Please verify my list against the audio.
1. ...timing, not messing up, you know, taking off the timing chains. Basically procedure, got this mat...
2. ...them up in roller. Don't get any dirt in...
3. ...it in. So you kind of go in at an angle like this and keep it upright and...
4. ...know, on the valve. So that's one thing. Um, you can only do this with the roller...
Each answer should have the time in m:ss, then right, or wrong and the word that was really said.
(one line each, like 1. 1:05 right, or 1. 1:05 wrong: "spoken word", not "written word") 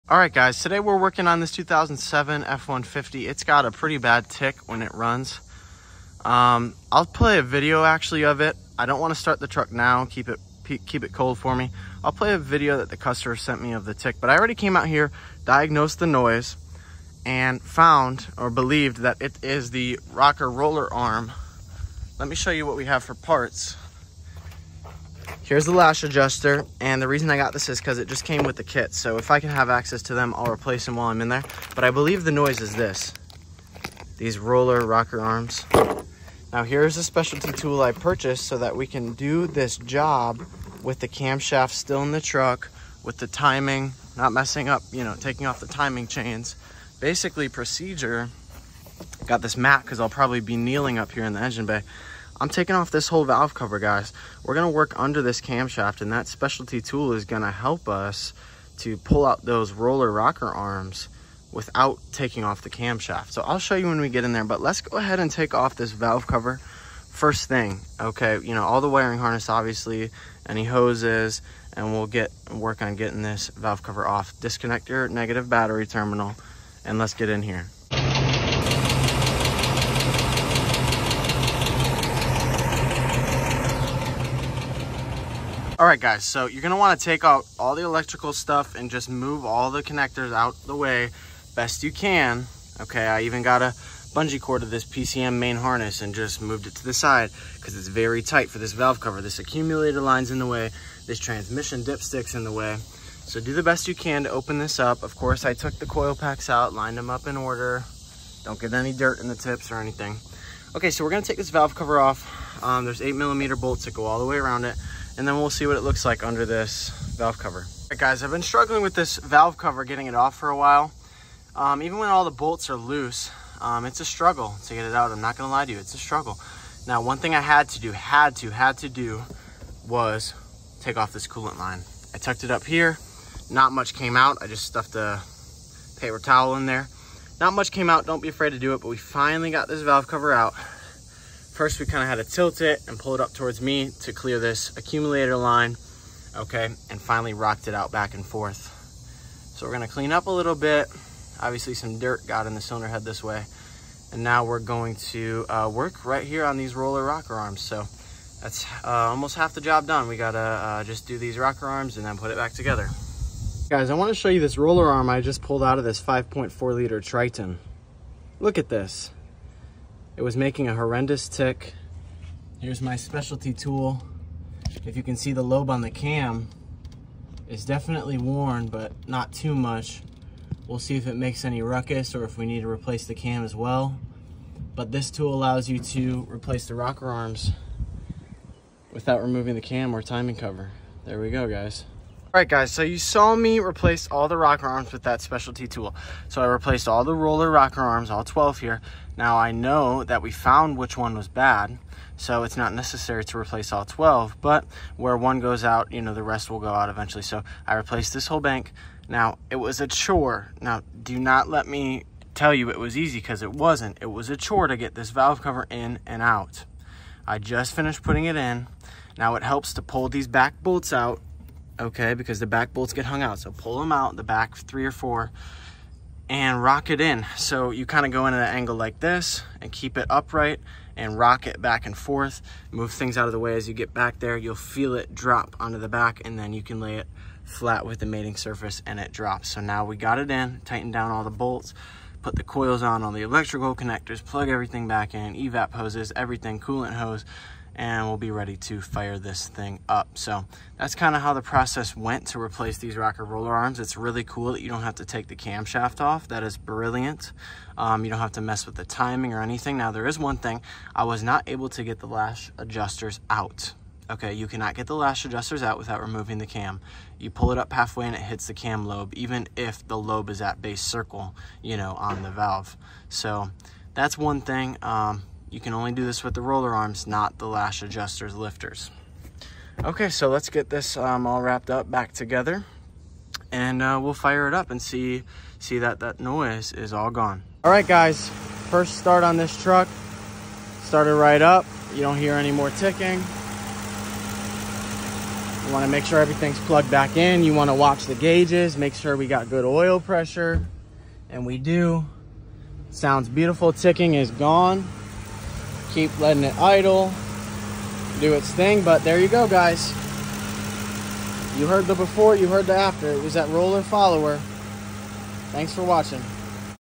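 1. 0:43 right
2. 1:46 wrong: "order", not "roller"
3. 3:46 right
4. 4:31 right.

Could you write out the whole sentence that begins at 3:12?
Alright guys, so you saw me replace all the rocker arms with that specialty tool.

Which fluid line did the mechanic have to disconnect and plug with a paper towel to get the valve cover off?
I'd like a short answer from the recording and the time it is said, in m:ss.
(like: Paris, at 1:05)
coolant line, at 2:11.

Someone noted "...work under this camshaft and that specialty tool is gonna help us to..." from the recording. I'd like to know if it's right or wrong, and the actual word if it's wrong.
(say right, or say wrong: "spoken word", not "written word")
right.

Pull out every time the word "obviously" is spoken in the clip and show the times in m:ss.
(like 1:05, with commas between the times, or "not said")
1:09, 2:31.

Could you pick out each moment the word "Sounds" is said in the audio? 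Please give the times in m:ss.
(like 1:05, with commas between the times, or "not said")
5:02.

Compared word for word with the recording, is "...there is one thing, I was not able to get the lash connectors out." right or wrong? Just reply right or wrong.
wrong.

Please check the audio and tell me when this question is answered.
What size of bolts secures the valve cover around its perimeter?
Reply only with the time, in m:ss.
1:53.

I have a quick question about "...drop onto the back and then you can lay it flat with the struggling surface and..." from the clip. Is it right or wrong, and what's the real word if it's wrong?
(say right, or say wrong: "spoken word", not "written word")
wrong: "mating", not "struggling".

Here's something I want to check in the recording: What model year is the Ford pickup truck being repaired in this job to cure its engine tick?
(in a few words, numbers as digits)
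2007.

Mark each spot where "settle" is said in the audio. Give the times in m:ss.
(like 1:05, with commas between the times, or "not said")
not said.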